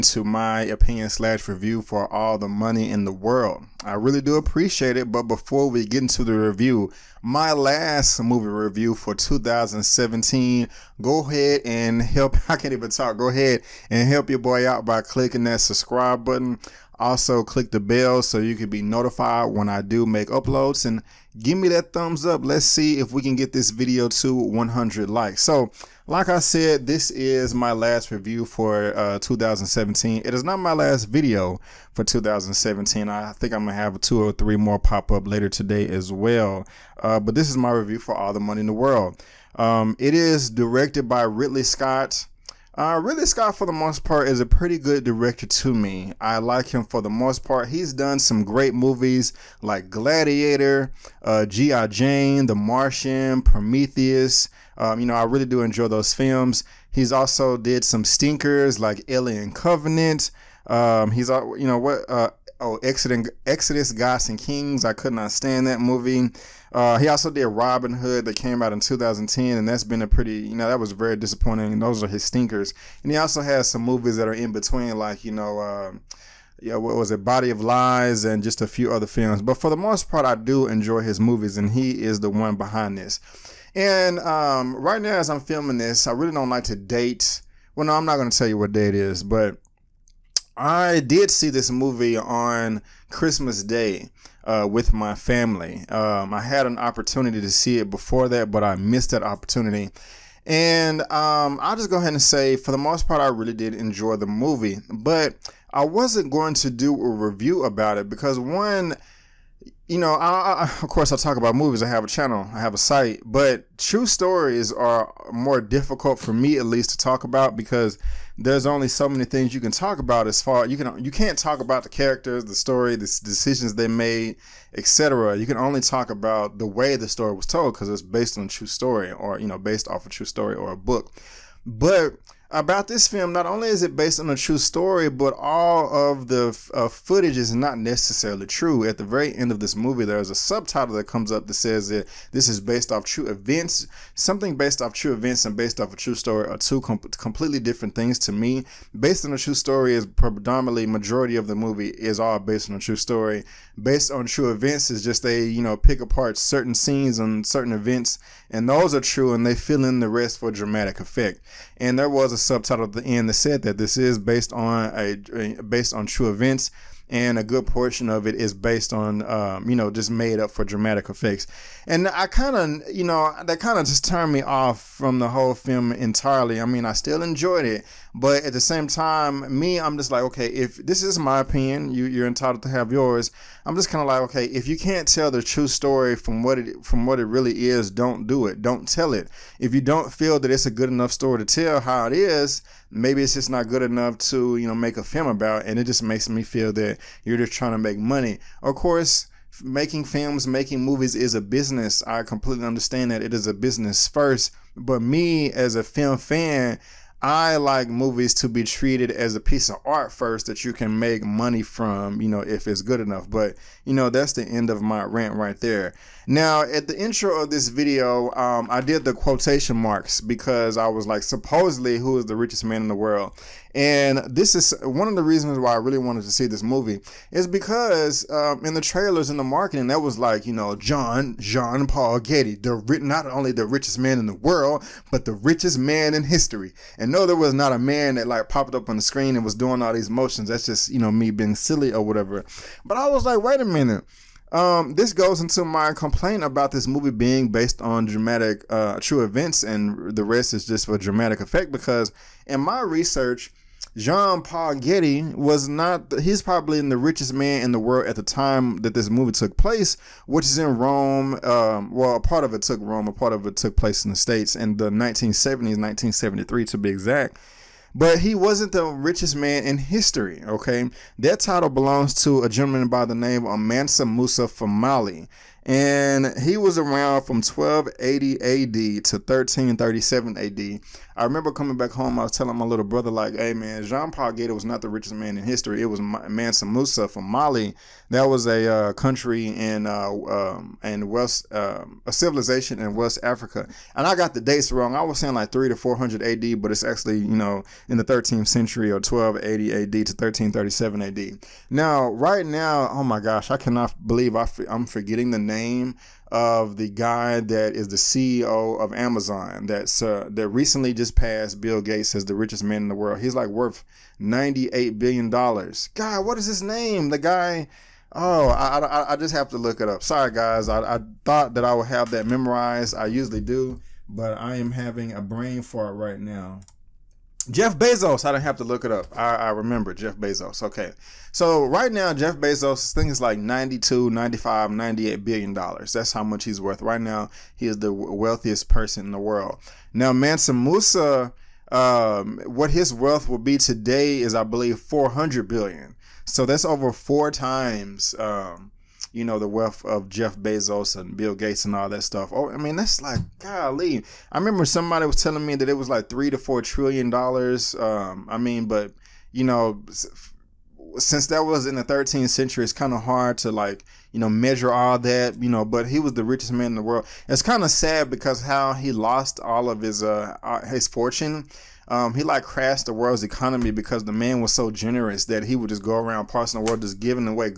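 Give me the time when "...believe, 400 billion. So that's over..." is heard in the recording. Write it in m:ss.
5:44.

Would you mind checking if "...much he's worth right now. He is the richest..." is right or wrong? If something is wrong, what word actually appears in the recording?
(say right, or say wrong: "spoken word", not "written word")
wrong: "wealthiest", not "richest".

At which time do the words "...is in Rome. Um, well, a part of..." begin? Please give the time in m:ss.
4:20.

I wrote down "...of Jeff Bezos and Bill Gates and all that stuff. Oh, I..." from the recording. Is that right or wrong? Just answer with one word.
right.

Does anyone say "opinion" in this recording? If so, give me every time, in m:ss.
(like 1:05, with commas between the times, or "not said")
0:00, 3:01.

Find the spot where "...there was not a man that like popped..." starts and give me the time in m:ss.
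3:57.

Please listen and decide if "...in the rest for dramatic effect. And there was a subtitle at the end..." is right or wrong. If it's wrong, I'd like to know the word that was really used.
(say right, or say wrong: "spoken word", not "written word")
right.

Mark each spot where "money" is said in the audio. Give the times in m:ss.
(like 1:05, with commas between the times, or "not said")
0:02, 0:38, 3:17, 3:31.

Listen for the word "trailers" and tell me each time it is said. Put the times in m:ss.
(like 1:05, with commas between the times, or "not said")
3:48.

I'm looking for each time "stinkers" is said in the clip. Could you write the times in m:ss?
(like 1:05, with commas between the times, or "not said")
0:58, 1:12.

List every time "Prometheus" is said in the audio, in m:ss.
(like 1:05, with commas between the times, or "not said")
0:53.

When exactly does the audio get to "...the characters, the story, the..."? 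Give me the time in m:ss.
2:01.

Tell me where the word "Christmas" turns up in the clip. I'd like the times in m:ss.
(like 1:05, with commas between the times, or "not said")
1:33.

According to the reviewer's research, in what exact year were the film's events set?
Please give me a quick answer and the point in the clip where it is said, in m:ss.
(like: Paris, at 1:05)
1973, at 4:25.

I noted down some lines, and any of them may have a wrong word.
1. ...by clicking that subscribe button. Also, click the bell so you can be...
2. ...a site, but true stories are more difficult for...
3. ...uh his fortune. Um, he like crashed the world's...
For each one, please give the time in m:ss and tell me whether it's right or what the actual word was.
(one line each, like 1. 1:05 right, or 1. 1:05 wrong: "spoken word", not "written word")
1. 0:14 right
2. 1:52 right
3. 6:10 right.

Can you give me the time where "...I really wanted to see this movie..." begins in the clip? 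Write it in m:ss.
3:45.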